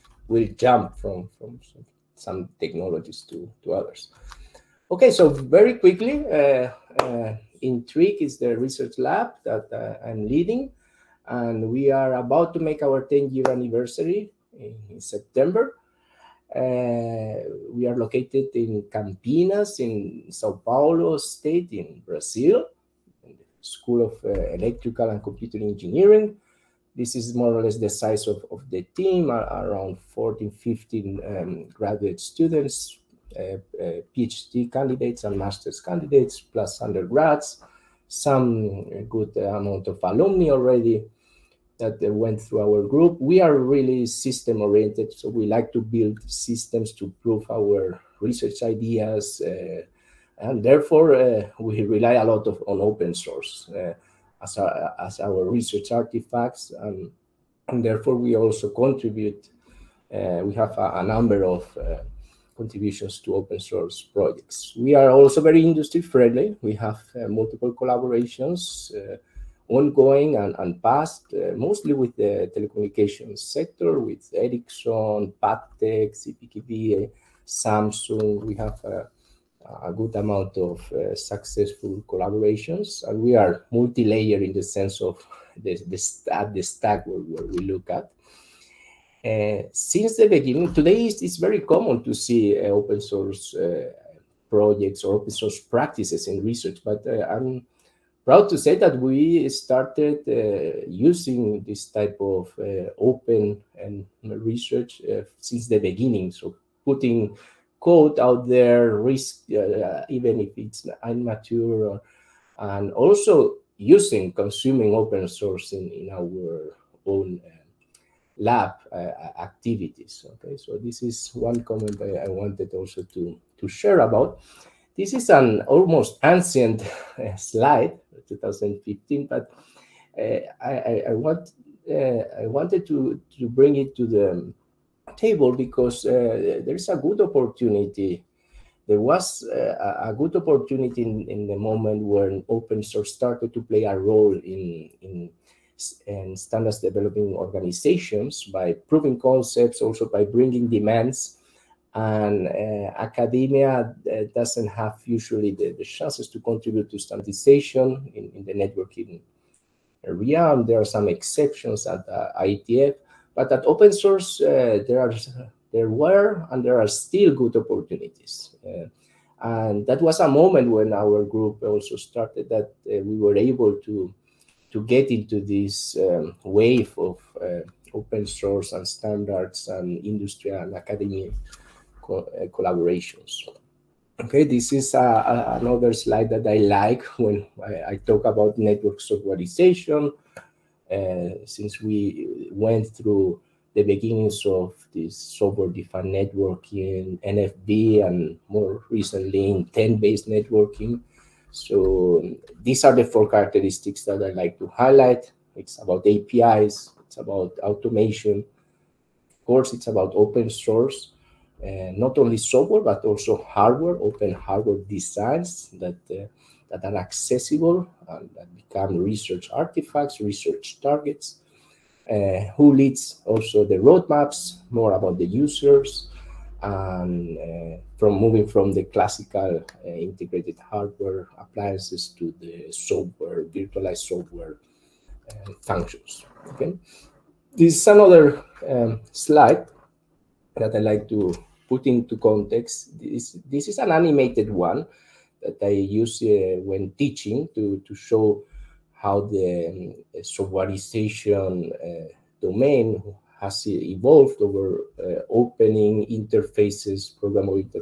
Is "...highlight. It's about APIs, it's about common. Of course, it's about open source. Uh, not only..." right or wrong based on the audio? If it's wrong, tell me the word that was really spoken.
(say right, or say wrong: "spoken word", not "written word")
wrong: "automation", not "common".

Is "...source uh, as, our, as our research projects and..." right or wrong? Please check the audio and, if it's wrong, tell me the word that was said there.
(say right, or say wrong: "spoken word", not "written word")
wrong: "artifacts", not "projects".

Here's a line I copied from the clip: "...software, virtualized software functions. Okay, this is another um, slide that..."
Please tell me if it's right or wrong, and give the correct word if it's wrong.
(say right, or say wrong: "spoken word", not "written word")
right.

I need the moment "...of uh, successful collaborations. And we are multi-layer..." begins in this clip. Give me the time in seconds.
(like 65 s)
80 s.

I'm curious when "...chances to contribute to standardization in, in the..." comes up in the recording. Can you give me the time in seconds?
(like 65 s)
155 s.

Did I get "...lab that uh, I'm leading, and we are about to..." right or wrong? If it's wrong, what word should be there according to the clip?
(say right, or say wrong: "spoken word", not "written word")
right.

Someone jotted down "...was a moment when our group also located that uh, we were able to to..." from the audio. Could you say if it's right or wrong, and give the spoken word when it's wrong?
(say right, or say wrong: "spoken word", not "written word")
wrong: "started", not "located".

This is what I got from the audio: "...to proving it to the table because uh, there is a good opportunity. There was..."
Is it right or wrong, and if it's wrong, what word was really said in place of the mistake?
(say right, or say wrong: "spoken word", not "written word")
wrong: "bring", not "proving".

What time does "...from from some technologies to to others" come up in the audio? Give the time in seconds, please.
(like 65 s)
0 s.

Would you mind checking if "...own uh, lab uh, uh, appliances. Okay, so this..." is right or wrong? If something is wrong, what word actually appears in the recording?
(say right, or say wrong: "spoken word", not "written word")
wrong: "activities", not "appliances".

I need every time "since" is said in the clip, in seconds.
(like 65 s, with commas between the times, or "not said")
89 s, 105 s, 191 s.